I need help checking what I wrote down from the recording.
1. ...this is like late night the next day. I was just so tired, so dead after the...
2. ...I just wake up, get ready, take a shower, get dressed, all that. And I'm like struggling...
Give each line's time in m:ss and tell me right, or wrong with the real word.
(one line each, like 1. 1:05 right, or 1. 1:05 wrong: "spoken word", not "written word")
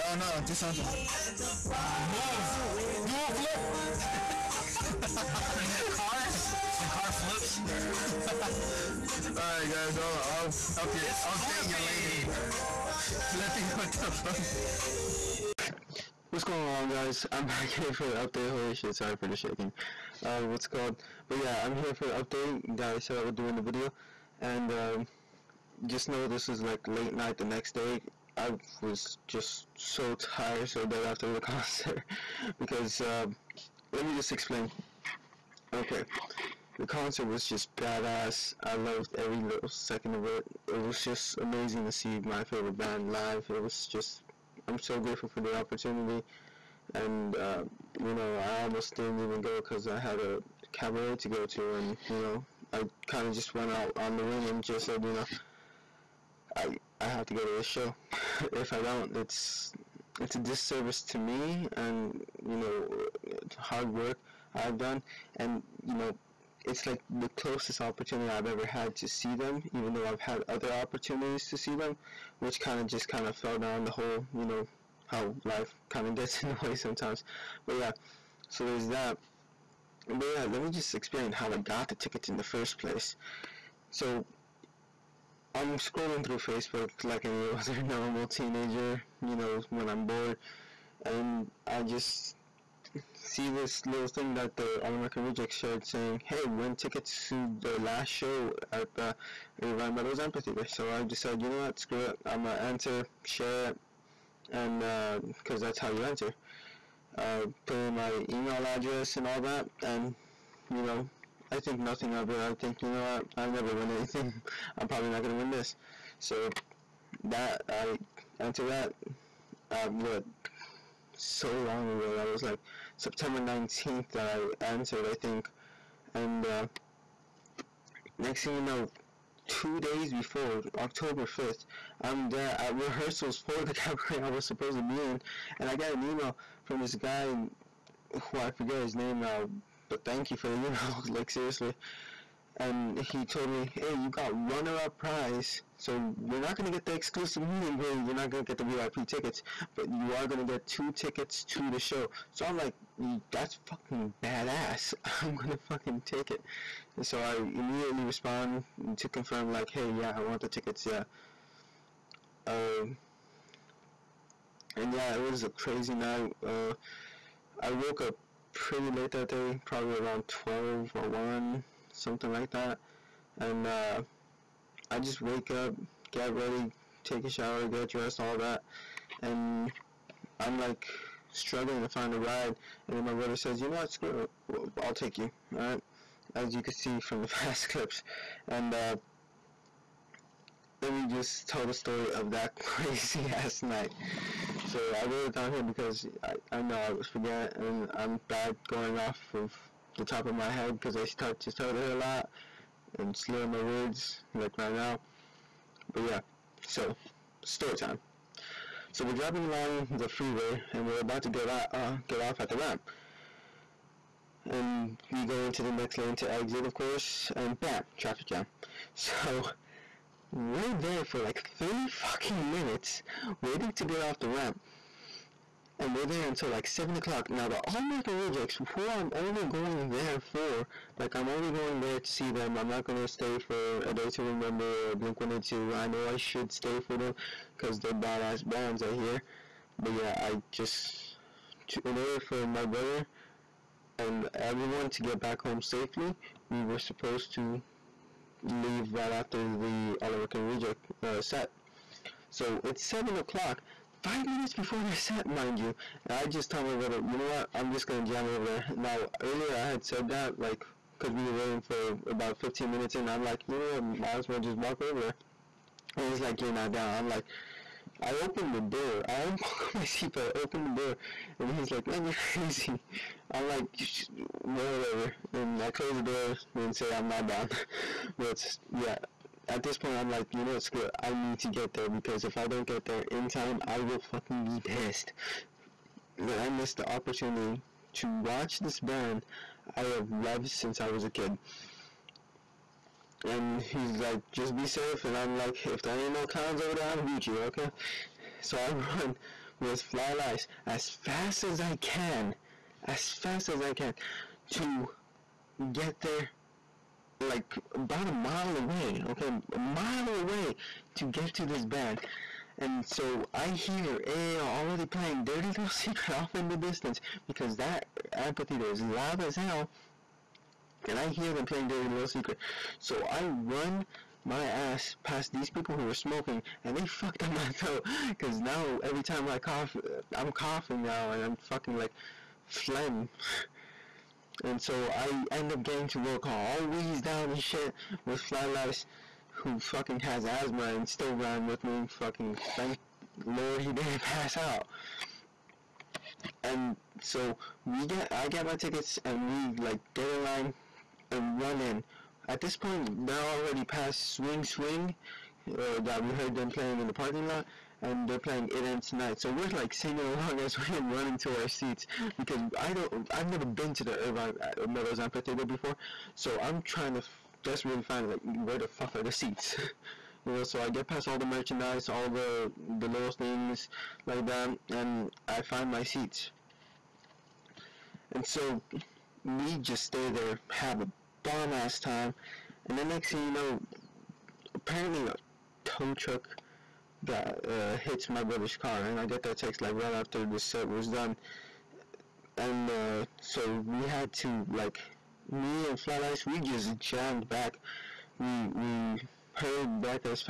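1. 0:26 right
2. 2:54 right.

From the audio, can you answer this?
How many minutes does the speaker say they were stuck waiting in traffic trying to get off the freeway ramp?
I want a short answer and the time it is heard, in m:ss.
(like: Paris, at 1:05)
30, at 3:41.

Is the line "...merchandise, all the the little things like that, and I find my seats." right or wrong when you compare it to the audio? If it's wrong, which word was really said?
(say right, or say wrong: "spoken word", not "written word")
right.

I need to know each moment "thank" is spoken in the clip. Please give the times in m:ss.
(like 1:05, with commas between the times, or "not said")
2:20, 5:42.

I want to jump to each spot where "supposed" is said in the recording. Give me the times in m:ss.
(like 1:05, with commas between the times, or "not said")
2:14, 4:06.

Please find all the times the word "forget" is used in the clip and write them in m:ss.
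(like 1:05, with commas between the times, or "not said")
2:18, 3:17.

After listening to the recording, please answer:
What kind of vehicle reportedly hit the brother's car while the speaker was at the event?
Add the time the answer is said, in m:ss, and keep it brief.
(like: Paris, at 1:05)
tow truck, at 6:25.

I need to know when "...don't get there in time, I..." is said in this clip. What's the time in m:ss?
4:42.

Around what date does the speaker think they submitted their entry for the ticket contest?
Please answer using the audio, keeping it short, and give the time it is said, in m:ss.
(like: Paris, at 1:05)
September 19th, at 2:02.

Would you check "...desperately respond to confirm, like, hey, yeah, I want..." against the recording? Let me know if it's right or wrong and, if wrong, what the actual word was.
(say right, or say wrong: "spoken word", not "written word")
wrong: "immediately", not "desperately".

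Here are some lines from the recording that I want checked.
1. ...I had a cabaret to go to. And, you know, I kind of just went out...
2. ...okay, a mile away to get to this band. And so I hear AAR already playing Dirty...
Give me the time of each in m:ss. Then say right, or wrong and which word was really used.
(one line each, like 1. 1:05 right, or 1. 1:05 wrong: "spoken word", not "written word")
1. 0:49 right
2. 5:09 right.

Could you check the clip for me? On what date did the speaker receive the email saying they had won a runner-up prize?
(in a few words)
October 5th.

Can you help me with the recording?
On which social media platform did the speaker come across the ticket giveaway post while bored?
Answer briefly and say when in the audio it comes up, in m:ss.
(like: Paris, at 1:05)
Facebook, at 1:26.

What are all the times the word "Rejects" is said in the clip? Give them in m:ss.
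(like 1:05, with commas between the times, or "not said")
1:35, 3:48, 4:10.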